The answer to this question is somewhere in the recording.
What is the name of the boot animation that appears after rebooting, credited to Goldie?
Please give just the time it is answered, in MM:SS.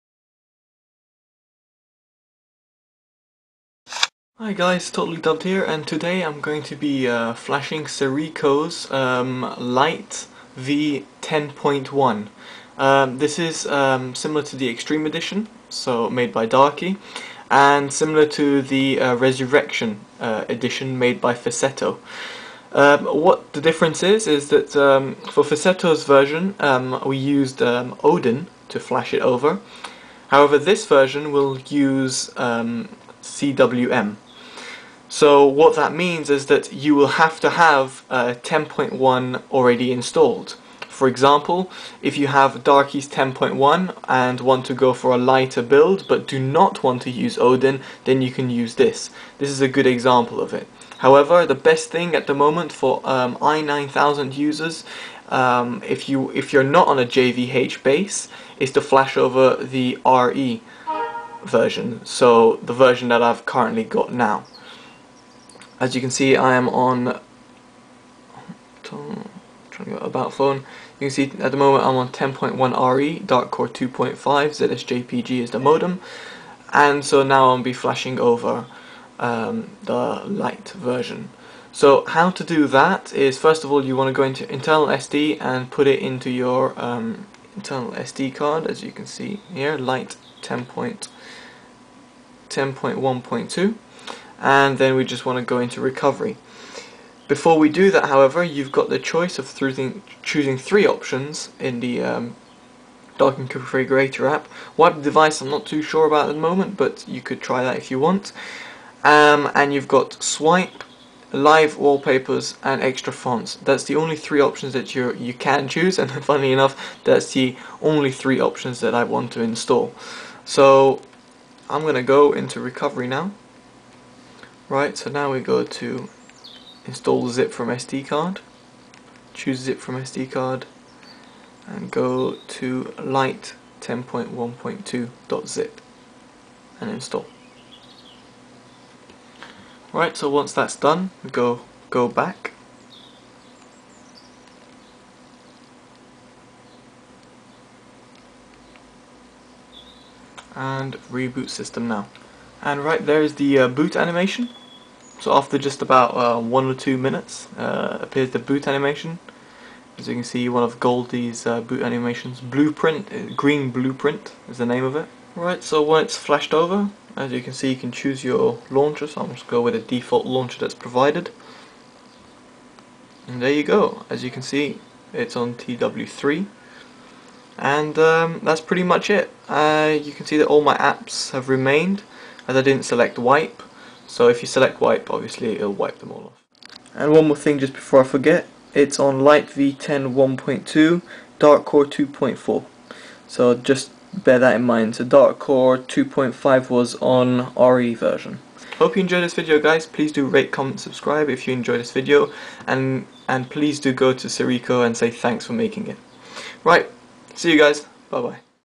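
02:43.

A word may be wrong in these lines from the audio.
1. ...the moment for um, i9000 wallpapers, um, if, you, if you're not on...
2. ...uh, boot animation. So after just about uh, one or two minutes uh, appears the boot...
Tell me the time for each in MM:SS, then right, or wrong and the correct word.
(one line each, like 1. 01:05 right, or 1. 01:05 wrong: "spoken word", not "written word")
1. 00:52 wrong: "users", not "wallpapers"
2. 02:33 right.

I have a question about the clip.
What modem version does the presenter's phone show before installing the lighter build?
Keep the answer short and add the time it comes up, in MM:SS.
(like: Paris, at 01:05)
ZSJPG, at 01:14.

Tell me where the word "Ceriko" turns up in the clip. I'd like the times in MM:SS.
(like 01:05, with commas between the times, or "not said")
00:07, 03:24.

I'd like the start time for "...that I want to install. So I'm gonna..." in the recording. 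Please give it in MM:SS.
01:58.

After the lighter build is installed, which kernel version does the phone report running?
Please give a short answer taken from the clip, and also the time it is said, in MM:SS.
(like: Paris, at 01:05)
Dark Core 2.4, at 03:11.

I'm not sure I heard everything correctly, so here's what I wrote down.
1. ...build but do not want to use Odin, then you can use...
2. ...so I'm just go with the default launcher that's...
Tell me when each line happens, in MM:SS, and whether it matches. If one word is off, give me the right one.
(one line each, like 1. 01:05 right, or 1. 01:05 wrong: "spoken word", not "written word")
1. 00:45 right
2. 02:49 right.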